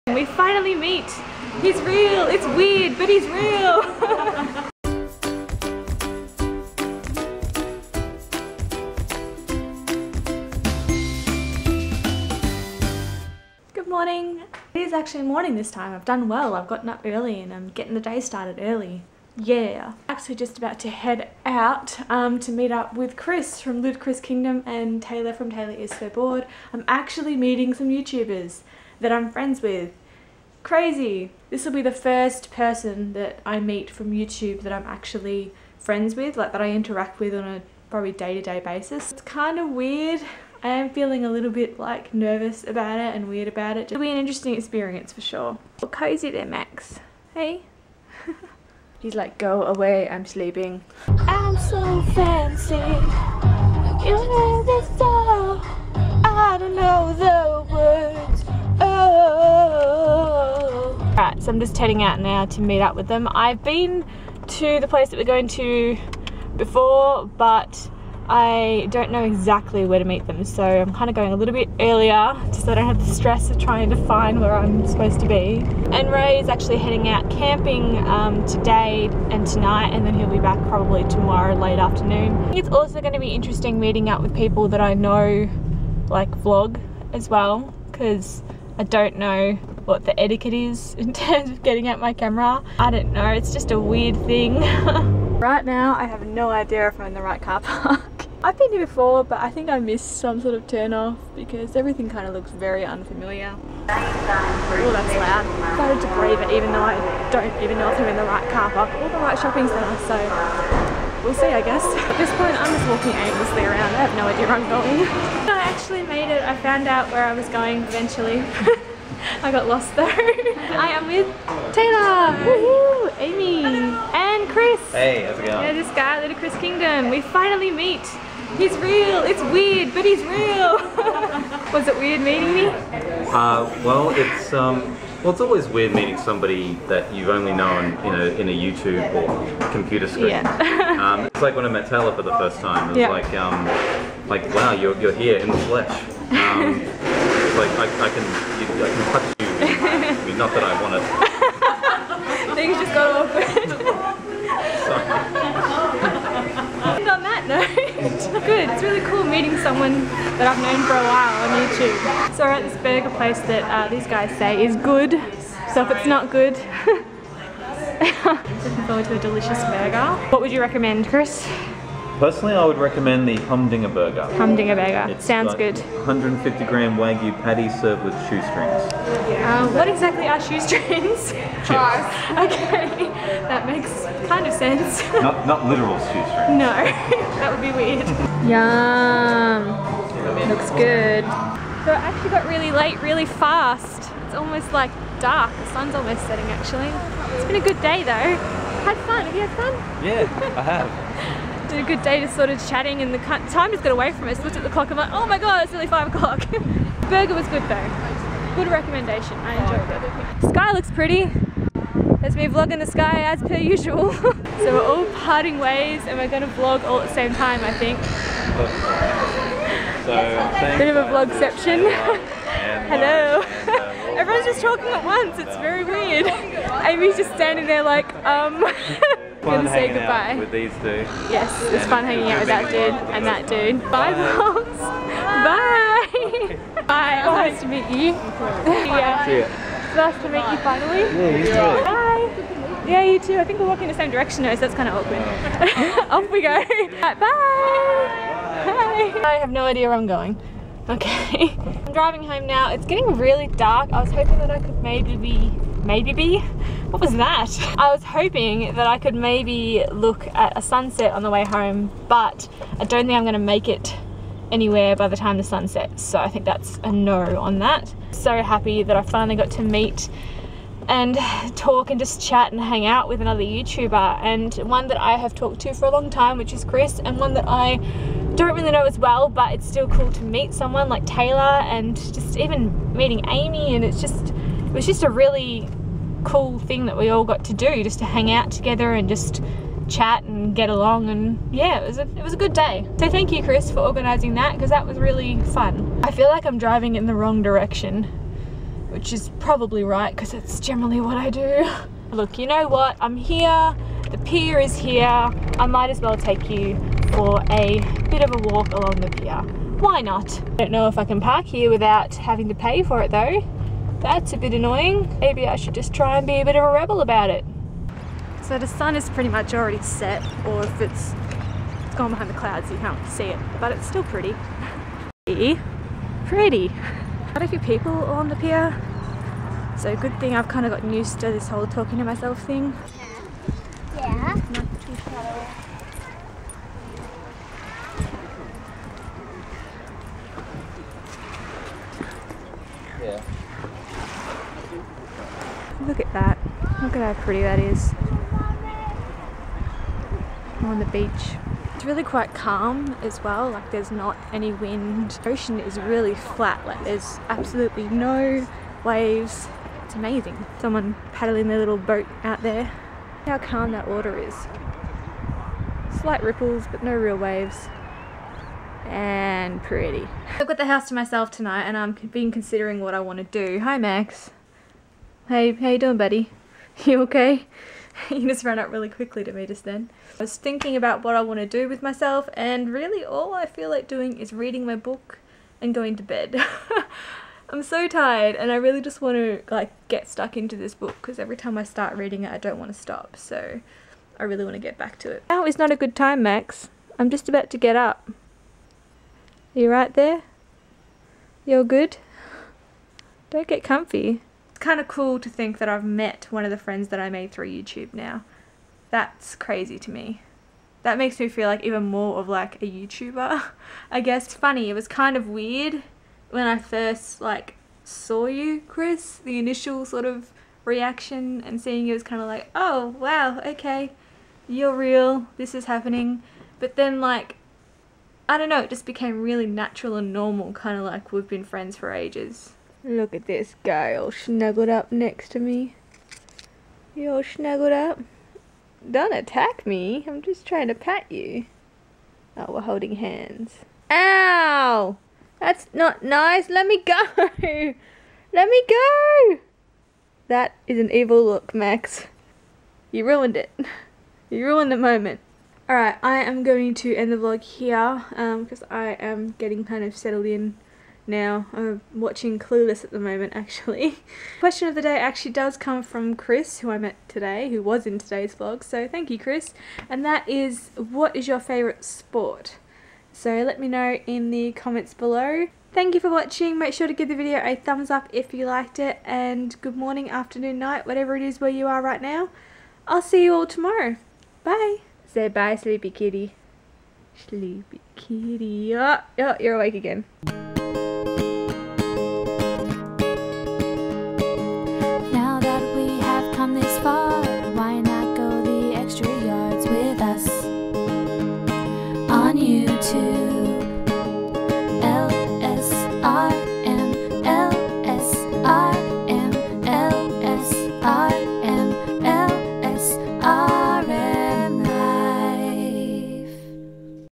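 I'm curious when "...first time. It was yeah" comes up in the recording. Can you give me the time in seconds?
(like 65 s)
142 s.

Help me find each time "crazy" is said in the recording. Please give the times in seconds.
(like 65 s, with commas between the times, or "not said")
30 s, 409 s.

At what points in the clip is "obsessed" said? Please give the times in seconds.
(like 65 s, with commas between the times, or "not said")
not said.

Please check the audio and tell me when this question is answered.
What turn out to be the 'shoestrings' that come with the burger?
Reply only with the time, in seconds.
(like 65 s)
181 s.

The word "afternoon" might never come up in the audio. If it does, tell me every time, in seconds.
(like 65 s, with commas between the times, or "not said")
81 s, 480 s.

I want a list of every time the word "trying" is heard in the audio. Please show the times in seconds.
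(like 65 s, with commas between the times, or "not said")
73 s, 440 s.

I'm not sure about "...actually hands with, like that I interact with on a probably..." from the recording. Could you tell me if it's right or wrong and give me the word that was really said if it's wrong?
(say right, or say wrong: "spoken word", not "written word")
wrong: "friends", not "hands".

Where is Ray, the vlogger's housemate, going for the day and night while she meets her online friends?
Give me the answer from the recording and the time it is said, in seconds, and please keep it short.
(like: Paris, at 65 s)
Camping, at 77 s.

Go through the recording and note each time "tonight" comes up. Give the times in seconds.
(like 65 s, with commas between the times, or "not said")
79 s, 371 s.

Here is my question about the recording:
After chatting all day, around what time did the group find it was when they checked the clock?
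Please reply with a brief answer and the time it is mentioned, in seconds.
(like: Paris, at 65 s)
5 o'clock, at 205 s.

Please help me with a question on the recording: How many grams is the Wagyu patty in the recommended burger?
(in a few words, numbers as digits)
150.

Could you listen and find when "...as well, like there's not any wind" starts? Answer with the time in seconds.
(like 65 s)
353 s.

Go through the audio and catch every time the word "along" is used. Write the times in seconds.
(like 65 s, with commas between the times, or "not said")
290 s, 308 s.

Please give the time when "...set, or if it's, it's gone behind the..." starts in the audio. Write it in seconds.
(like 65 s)
319 s.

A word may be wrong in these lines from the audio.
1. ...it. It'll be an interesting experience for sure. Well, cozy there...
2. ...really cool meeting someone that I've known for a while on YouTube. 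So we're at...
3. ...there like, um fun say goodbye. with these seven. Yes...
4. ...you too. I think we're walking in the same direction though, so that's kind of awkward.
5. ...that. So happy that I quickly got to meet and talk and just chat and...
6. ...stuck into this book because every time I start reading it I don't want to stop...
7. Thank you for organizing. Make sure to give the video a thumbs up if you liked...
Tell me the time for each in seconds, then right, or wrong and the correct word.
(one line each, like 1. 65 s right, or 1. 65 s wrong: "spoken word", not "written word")
1. 43 s right
2. 158 s right
3. 227 s wrong: "two", not "seven"
4. 243 s right
5. 267 s wrong: "finally", not "quickly"
6. 390 s right
7. 475 s wrong: "watching", not "organizing".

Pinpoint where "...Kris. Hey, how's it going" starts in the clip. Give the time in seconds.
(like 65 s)
124 s.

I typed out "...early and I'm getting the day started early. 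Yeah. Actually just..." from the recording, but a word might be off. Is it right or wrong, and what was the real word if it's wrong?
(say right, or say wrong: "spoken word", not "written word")
right.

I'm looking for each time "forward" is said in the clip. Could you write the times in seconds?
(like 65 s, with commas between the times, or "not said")
168 s.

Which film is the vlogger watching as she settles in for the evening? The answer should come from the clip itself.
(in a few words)
Clueless.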